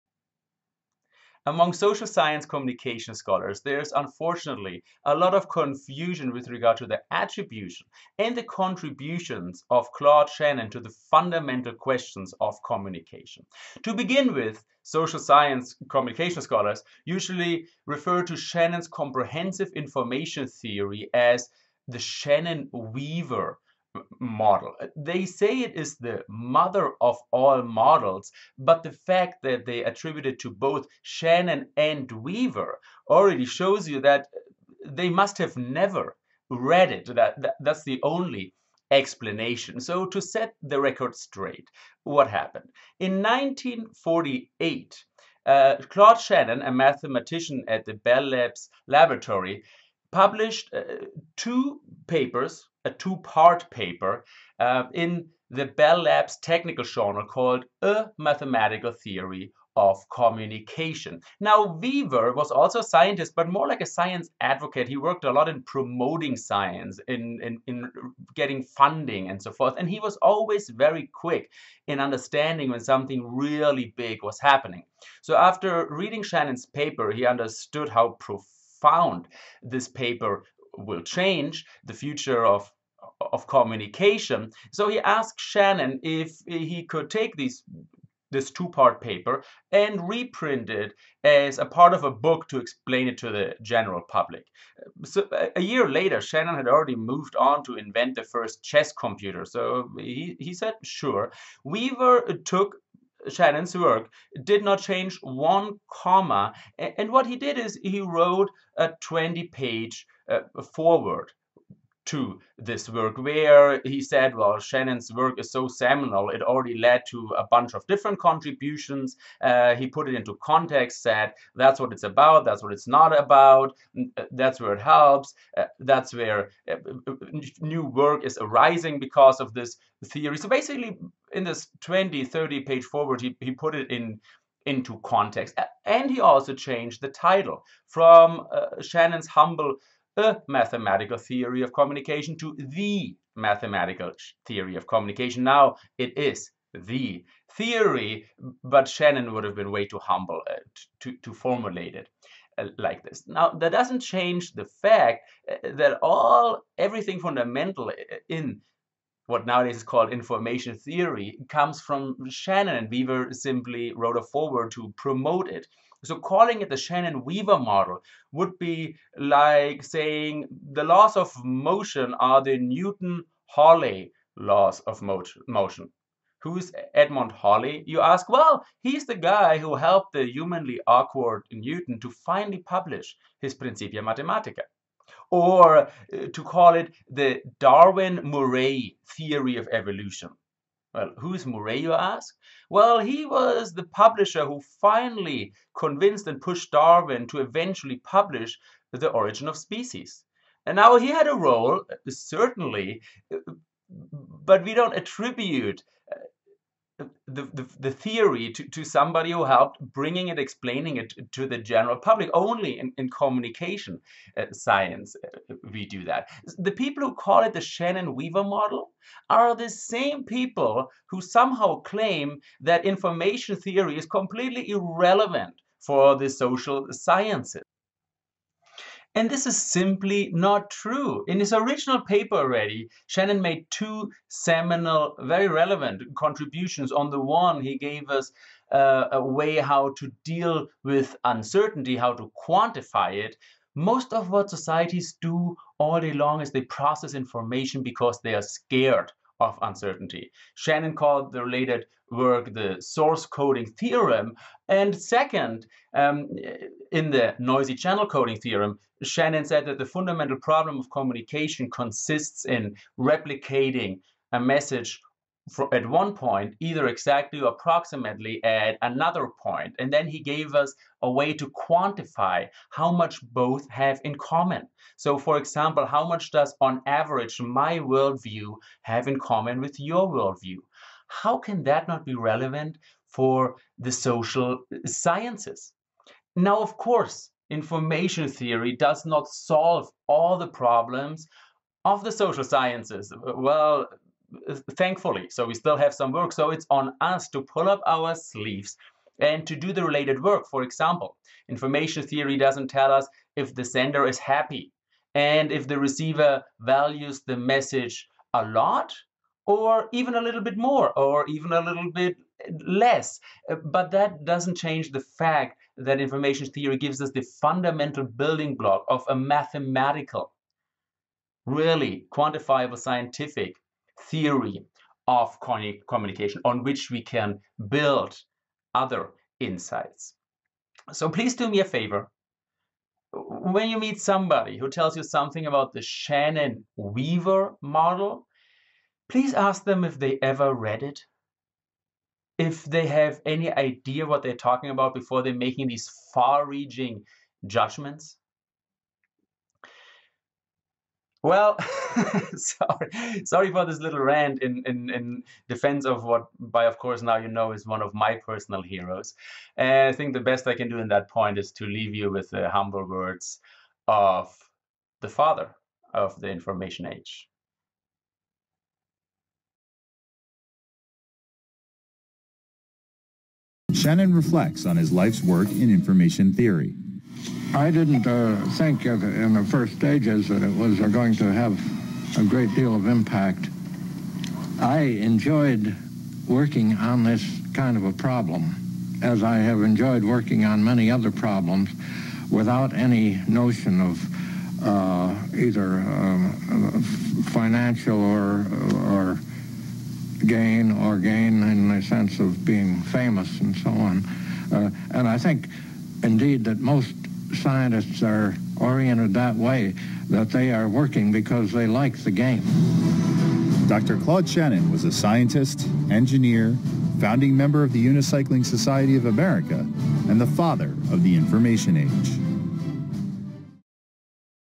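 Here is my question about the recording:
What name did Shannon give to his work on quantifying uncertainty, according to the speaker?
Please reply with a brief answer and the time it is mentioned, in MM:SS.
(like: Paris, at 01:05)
source coding theorem, at 04:12.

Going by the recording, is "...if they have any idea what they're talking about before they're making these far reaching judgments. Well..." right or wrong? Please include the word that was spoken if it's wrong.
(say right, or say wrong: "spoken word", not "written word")
right.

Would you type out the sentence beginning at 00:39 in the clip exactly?
So to set the record straight, what happened?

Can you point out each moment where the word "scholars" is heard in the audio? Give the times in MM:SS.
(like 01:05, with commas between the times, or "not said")
00:03, 00:16.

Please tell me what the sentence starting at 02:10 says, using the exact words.
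So basically, in this 20, 30 page forward, he, he put it in into context.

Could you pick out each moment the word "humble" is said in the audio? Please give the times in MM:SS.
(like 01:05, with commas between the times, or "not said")
02:19, 02:29, 06:02.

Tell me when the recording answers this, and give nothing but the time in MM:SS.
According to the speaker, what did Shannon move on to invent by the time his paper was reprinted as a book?
01:38.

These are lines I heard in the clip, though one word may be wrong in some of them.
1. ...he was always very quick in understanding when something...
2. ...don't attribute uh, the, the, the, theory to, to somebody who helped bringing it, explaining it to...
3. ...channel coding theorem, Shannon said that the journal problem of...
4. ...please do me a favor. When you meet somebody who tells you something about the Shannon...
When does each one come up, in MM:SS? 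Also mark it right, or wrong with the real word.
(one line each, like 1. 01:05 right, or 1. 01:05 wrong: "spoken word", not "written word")
1. 01:09 right
2. 03:24 right
3. 04:17 wrong: "fundamental", not "journal"
4. 05:31 right.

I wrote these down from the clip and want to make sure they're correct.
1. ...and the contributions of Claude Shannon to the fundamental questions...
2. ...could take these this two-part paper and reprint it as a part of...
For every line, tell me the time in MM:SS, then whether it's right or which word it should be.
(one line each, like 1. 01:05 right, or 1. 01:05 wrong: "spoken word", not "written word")
1. 00:08 right
2. 01:26 right.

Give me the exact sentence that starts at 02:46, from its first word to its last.
So calling it the Shannon Weaver model would be like saying the laws of motion are the Newton Halley laws of motion.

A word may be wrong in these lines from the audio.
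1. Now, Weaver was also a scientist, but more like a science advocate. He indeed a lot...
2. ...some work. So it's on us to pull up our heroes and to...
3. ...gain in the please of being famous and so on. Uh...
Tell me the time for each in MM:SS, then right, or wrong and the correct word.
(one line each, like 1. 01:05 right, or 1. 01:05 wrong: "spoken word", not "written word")
1. 01:01 wrong: "worked", not "indeed"
2. 04:55 wrong: "sleeves", not "heroes"
3. 06:40 wrong: "sense", not "please".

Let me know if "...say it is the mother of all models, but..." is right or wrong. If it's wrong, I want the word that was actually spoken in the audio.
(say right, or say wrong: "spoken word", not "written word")
right.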